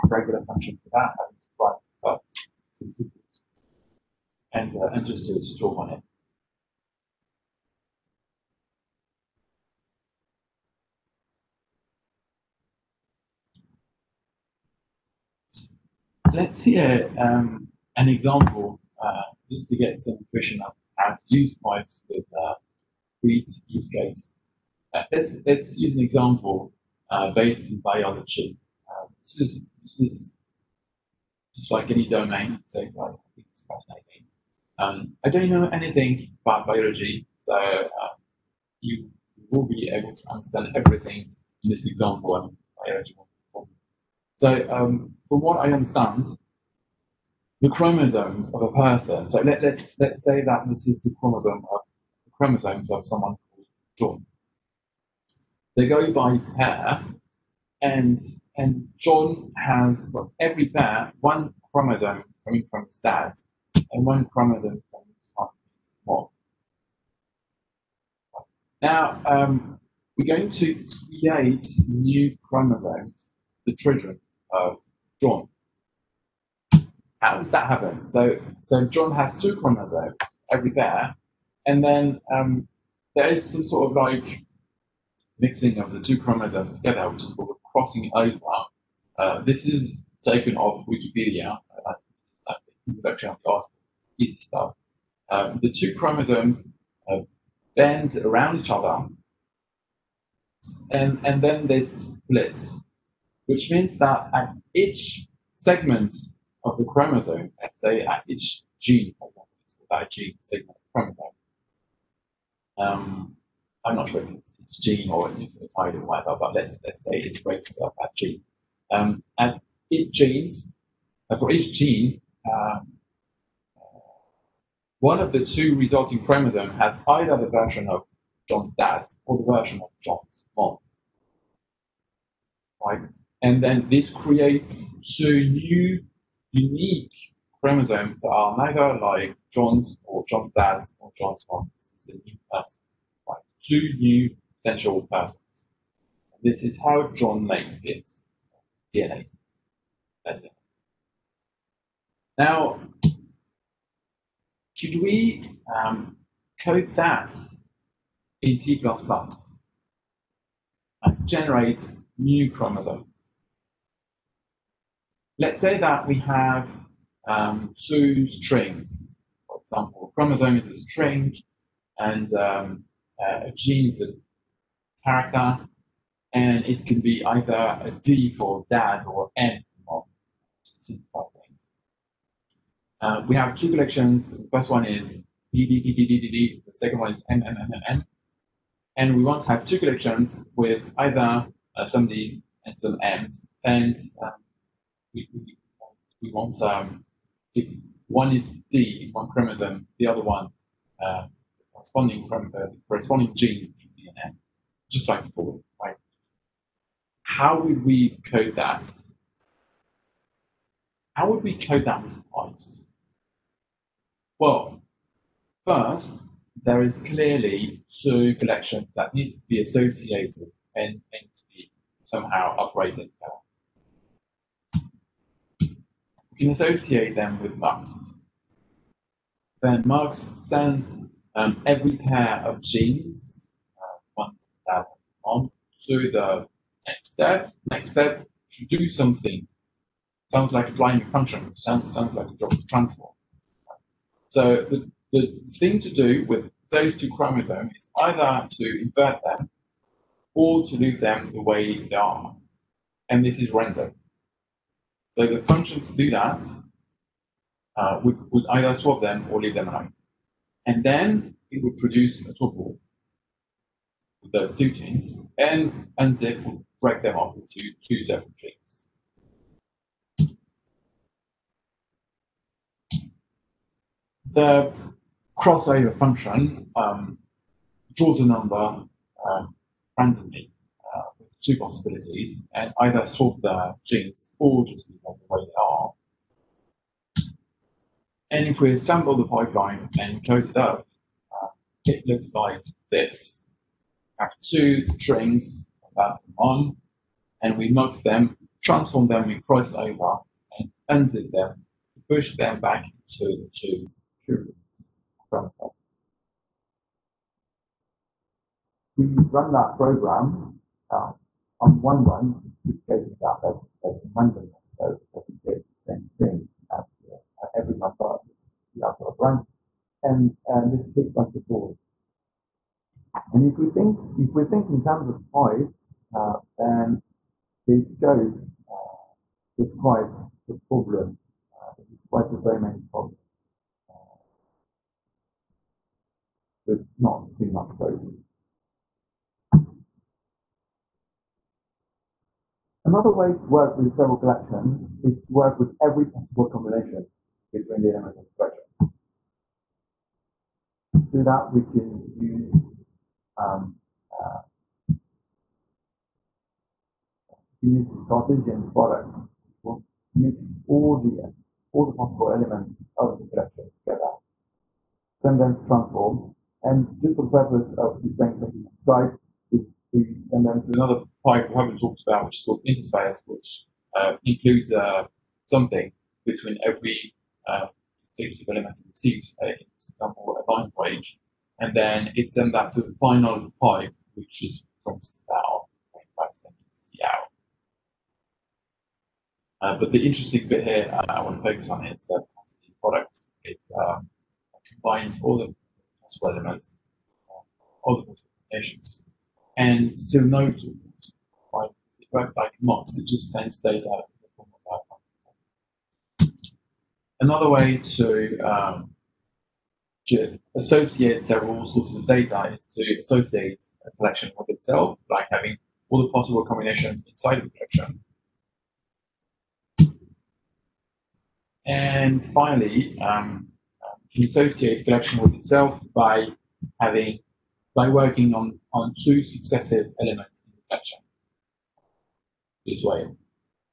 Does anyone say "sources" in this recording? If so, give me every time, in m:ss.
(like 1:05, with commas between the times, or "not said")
6:51.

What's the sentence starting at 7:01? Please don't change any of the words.
And finally, um, can associate collection with itself by having by working on, on two successive elements in the collection this way.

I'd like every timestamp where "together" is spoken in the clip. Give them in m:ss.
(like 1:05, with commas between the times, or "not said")
1:26, 3:43, 6:03.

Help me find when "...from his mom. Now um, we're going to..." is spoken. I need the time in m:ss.
1:05.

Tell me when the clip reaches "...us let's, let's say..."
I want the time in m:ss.
0:49.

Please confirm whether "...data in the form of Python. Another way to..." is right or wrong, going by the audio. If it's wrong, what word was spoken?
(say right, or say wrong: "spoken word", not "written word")
right.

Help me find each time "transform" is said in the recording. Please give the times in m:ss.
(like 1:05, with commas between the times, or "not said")
4:02, 4:58, 6:05.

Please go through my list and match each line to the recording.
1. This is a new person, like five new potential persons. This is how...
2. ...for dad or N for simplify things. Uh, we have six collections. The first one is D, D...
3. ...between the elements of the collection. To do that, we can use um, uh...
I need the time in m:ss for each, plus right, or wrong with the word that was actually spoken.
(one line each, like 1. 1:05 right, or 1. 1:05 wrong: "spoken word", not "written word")
1. 2:21 wrong: "two", not "five"
2. 2:58 wrong: "two", not "six"
3. 5:47 right.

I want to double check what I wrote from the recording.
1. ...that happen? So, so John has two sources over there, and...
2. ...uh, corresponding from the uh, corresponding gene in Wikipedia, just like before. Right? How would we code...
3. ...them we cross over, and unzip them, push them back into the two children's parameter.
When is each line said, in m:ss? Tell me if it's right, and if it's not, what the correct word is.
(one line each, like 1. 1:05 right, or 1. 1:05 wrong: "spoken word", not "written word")
1. 1:17 wrong: "chromosomes", not "sources"
2. 3:21 wrong: "DNA", not "Wikipedia"
3. 4:59 right.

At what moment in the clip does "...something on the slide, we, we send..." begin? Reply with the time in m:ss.
6:08.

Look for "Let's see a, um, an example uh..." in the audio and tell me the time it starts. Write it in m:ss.
0:16.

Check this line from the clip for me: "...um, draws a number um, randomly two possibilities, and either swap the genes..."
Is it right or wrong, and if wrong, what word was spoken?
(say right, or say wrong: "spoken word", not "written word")
right.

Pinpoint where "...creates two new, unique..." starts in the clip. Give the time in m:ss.
2:14.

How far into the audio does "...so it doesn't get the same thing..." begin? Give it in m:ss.
5:14.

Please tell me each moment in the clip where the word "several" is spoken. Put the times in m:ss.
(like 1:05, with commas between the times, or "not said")
5:43, 6:51.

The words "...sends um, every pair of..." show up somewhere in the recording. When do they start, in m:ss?
3:50.